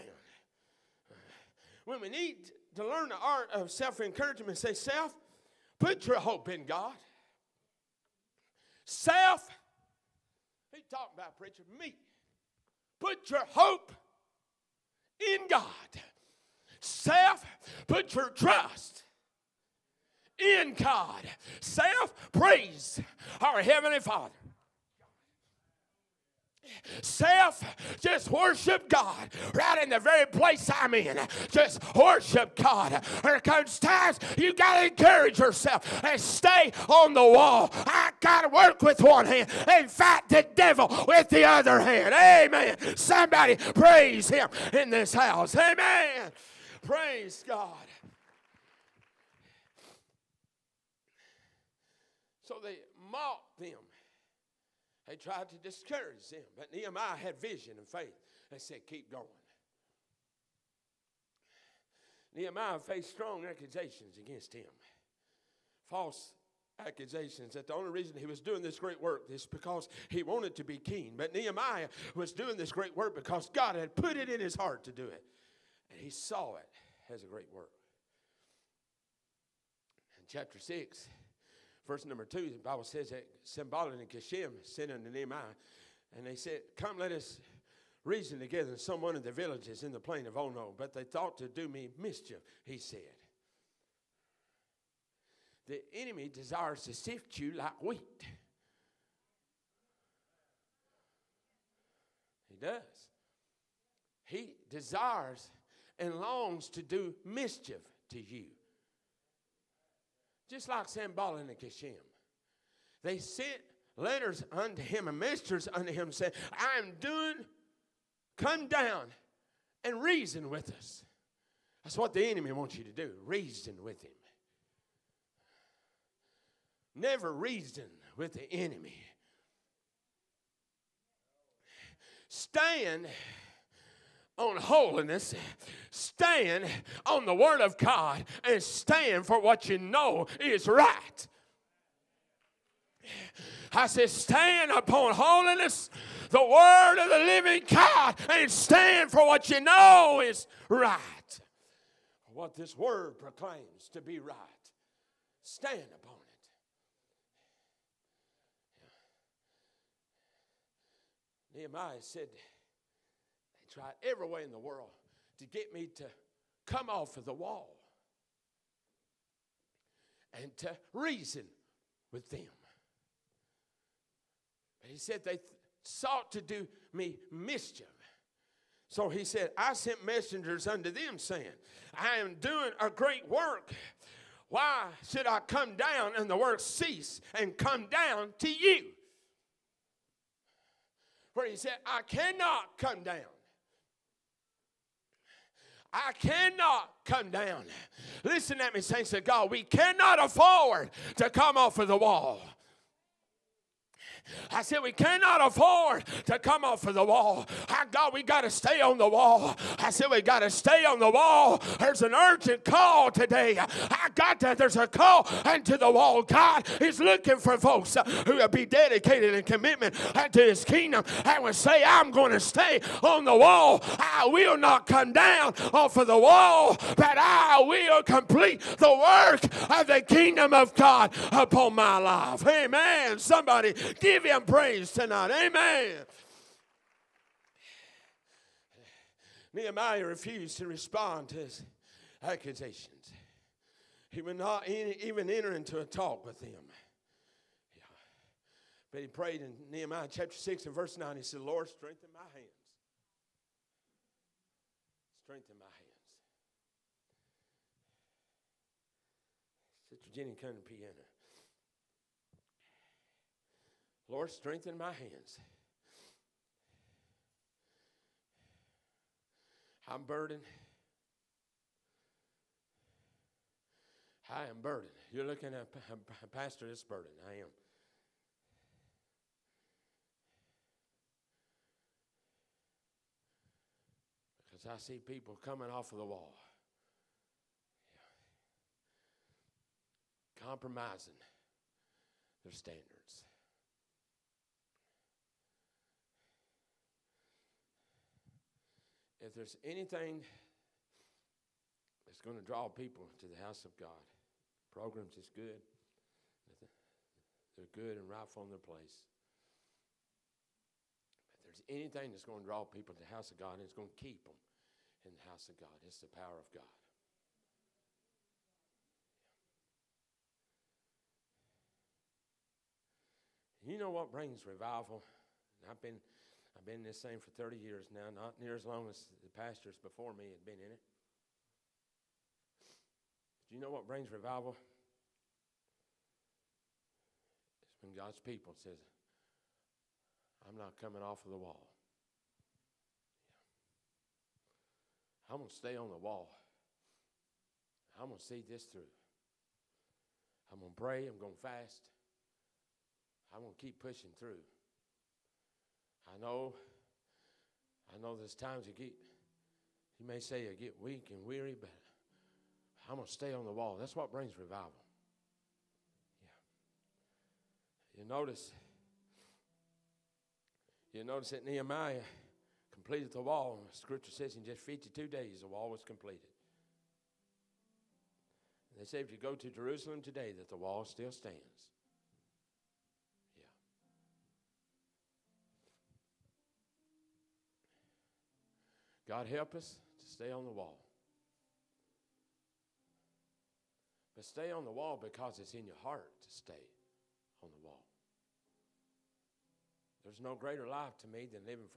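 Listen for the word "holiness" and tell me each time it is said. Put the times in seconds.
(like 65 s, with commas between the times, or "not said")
134 s, 145 s.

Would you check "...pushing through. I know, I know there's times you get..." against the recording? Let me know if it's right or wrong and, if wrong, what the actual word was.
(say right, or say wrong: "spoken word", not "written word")
right.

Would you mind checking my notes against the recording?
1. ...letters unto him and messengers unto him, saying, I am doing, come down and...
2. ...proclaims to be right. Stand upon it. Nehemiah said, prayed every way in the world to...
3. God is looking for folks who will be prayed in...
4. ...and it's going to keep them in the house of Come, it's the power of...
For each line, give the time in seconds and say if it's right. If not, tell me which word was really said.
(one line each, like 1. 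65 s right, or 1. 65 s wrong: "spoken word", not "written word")
1. 113 s right
2. 153 s wrong: "tried", not "prayed"
3. 216 s wrong: "dedicated", not "prayed"
4. 313 s wrong: "God", not "Come".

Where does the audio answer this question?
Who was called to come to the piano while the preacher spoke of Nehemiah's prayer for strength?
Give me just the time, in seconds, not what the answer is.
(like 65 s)
259 s.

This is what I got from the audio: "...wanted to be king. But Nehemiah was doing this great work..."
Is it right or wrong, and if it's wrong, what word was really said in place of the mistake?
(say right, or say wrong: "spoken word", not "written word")
right.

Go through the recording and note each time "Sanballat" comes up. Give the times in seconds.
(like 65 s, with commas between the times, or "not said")
83 s, 110 s.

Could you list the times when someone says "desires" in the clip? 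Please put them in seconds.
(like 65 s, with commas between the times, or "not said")
96 s, 104 s.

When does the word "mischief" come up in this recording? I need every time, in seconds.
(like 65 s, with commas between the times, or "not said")
91 s, 107 s, 177 s.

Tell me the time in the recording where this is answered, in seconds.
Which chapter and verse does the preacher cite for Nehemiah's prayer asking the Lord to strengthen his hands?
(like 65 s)
249 s.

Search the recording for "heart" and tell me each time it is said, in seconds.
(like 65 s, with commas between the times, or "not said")
74 s, 395 s.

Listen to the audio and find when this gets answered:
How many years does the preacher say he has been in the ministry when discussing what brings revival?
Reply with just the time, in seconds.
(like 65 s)
327 s.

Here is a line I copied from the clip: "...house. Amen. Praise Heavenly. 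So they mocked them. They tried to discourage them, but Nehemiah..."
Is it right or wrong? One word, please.
wrong.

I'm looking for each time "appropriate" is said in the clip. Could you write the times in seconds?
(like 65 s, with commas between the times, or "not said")
not said.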